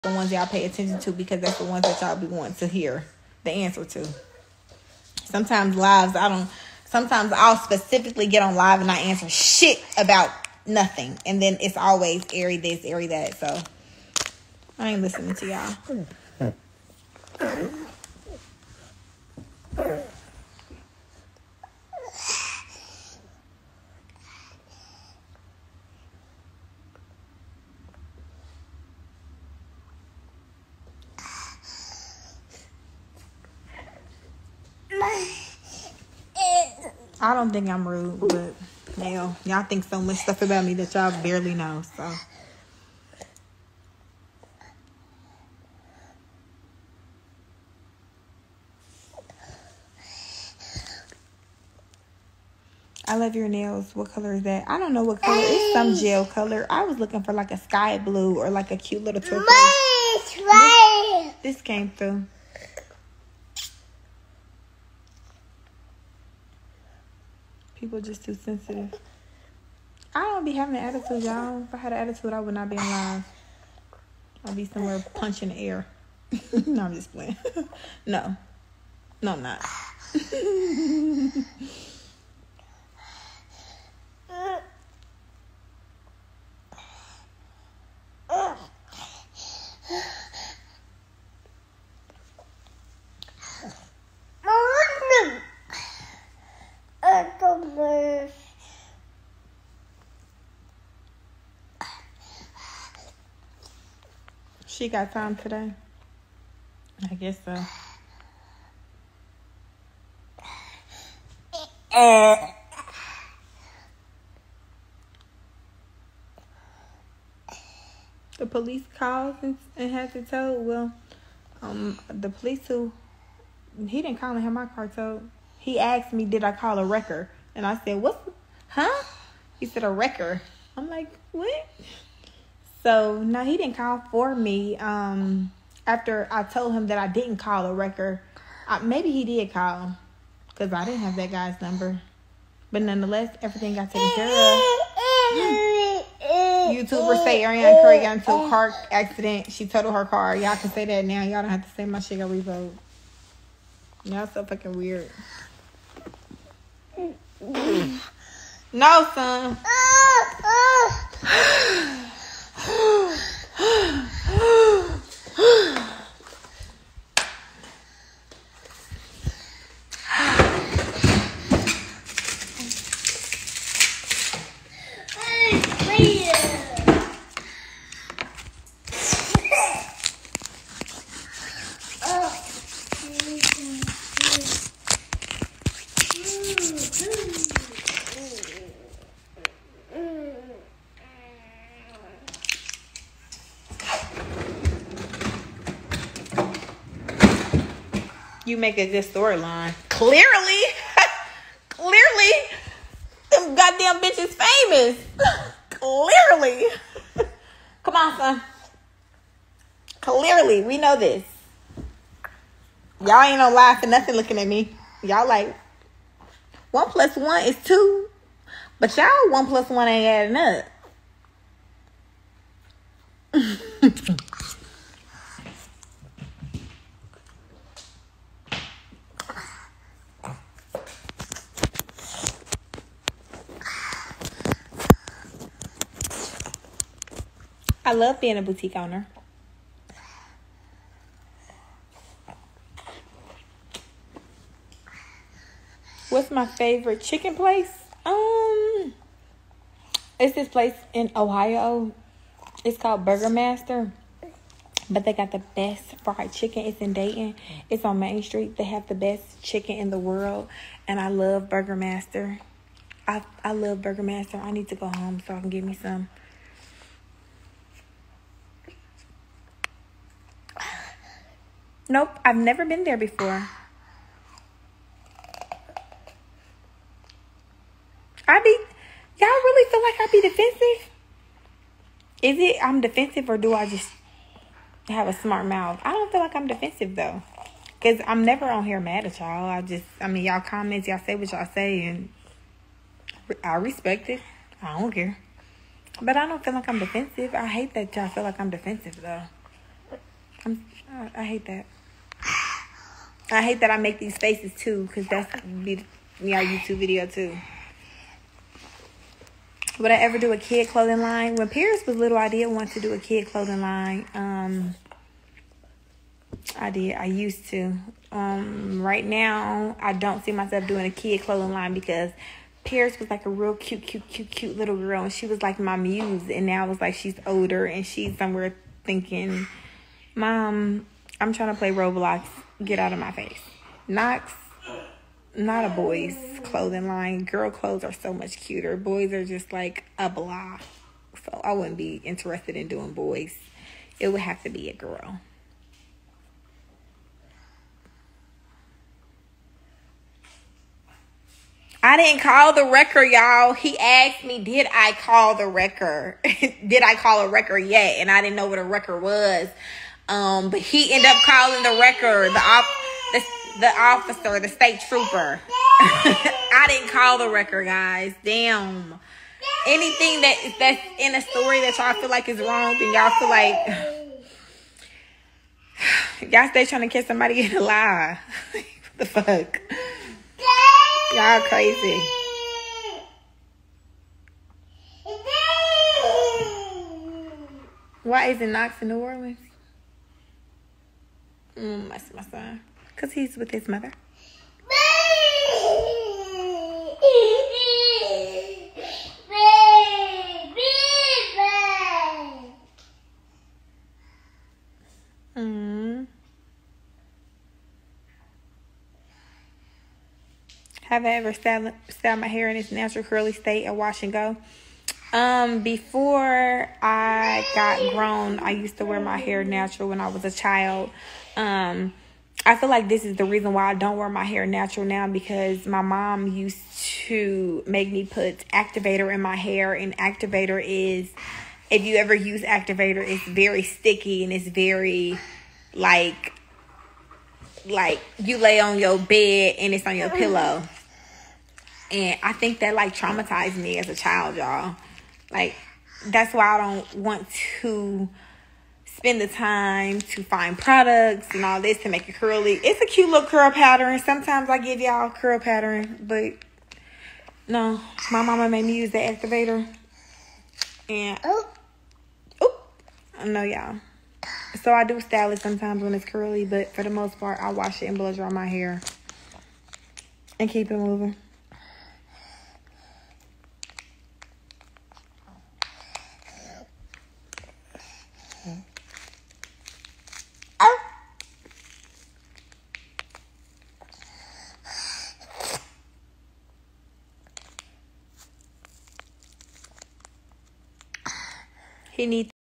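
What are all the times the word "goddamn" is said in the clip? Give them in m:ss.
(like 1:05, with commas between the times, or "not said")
3:23.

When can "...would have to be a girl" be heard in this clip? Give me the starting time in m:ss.
5:44.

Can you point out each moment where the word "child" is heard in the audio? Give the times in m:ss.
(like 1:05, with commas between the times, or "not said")
7:00, 7:23.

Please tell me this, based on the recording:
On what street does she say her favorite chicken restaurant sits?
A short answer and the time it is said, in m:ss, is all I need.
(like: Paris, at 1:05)
Main Street, at 4:17.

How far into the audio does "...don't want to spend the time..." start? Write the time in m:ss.
7:26.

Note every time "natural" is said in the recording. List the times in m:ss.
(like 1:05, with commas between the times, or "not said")
6:52, 6:59, 7:04.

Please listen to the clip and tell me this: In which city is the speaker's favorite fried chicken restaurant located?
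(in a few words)
Dayton.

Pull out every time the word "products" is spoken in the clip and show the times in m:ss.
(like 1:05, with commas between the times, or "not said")
7:30.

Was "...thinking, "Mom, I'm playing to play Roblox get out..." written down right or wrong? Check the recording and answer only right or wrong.
wrong.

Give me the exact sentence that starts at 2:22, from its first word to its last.
But nonetheless, everything got taken care of.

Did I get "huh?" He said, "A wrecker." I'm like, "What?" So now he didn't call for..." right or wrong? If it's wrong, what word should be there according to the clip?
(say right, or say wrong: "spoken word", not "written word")
right.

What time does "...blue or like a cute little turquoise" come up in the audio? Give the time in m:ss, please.
0:57.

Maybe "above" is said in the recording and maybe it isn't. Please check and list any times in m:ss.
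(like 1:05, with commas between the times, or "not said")
not said.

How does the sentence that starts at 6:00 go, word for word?
Um, but he ended up calling the record, the op, the, the officer, the state trooper.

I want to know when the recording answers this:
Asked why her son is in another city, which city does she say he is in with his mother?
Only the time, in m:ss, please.
6:28.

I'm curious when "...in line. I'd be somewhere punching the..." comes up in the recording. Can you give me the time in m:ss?
1:12.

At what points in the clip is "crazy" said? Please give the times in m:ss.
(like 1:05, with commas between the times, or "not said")
6:21.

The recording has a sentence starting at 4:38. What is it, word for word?
I be, y'all really feel like I be defensive?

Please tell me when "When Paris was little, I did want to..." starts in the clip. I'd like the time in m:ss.
5:11.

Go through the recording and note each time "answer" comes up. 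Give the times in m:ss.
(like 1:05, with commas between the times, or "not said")
0:03, 0:08.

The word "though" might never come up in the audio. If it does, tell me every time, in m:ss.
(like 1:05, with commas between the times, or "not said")
4:46, 4:59.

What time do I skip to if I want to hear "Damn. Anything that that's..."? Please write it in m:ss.
6:08.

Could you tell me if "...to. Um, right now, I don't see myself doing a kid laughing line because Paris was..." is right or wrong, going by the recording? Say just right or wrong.
wrong.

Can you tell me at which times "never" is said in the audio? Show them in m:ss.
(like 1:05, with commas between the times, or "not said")
4:32, 4:48.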